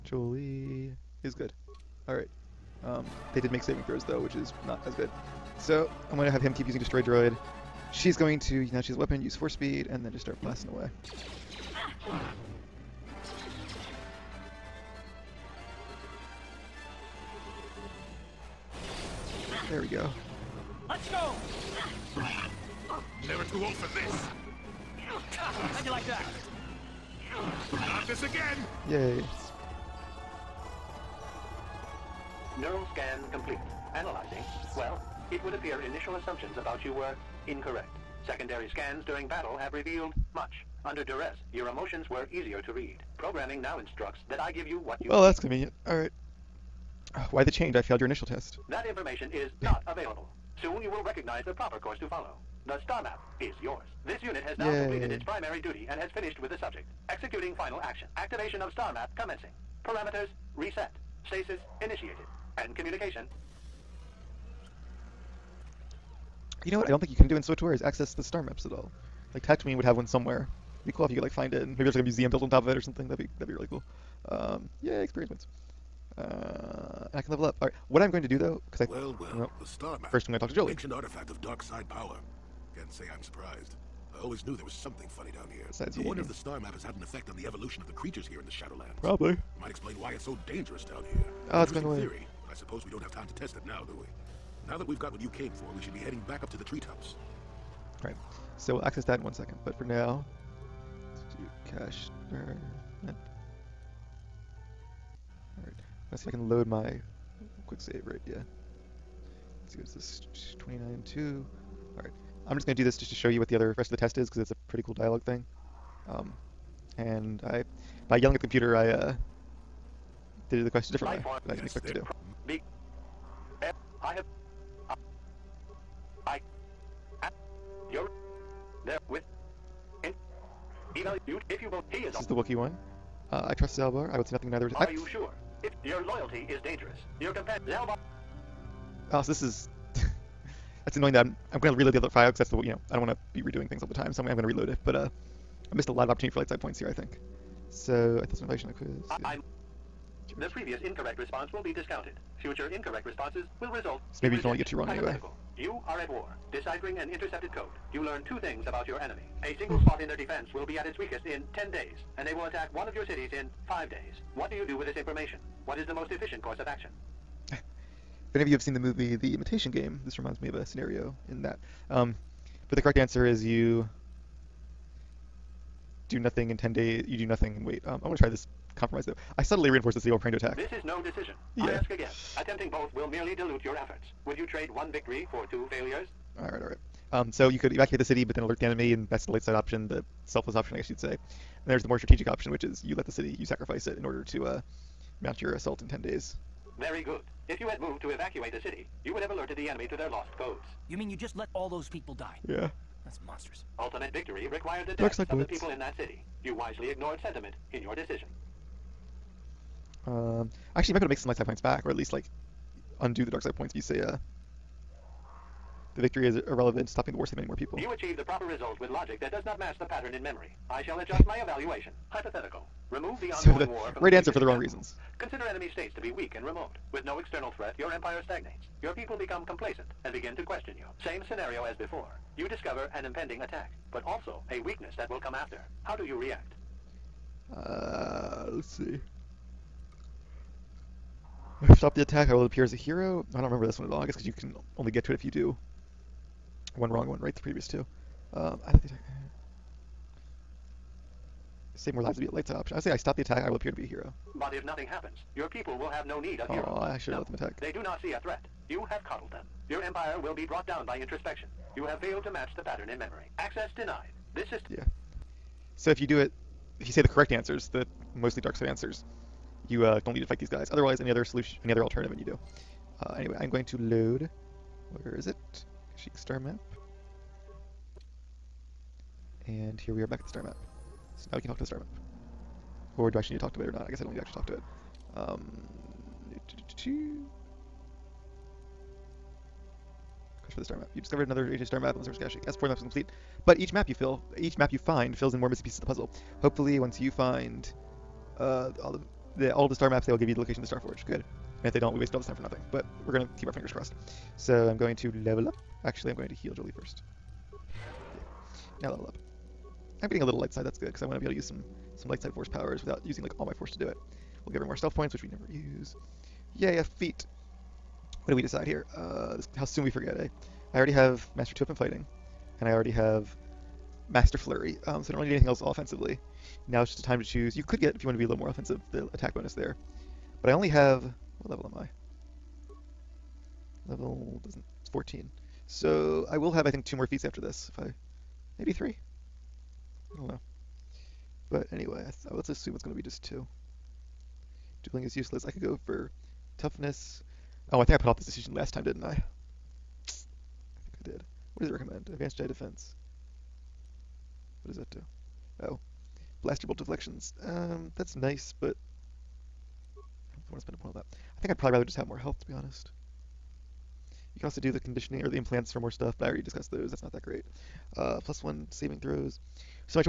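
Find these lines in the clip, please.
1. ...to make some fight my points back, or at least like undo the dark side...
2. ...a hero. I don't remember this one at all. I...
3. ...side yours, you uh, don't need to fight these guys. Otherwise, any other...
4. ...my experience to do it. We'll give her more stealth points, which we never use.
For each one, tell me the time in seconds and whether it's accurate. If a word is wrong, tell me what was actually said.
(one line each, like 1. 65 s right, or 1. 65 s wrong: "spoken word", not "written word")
1. 211 s wrong: "light", not "fight"
2. 242 s right
3. 268 s wrong: "answers", not "yours"
4. 313 s wrong: "force", not "experience".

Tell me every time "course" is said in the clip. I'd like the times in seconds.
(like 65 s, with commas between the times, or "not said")
51 s, 166 s.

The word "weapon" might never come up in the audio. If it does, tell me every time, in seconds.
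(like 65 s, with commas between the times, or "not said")
8 s, 321 s.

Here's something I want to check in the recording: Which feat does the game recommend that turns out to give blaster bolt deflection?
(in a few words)
Advanced Jedi Defense.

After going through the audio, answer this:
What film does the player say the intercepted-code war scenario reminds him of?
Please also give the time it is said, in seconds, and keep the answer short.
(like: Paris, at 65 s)
The Imitation Game, at 169 s.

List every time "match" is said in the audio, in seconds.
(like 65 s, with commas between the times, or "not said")
219 s, 262 s.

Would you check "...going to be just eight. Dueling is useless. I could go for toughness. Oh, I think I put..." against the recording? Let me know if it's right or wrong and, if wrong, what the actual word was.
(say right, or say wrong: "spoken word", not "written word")
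wrong: "two", not "eight".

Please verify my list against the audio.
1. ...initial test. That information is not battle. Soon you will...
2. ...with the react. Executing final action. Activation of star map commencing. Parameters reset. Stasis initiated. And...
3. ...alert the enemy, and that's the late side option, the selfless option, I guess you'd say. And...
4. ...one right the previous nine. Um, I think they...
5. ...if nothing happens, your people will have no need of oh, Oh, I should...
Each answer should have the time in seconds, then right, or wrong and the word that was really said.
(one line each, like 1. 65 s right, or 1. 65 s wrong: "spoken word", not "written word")
1. 48 s wrong: "available", not "battle"
2. 56 s wrong: "subject", not "react"
3. 188 s right
4. 247 s wrong: "two", not "nine"
5. 254 s right.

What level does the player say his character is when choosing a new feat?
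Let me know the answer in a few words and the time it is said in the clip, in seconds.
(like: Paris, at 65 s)
14, at 334 s.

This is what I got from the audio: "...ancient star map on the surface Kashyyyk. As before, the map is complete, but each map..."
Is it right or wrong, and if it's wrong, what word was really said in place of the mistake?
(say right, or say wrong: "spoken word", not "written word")
right.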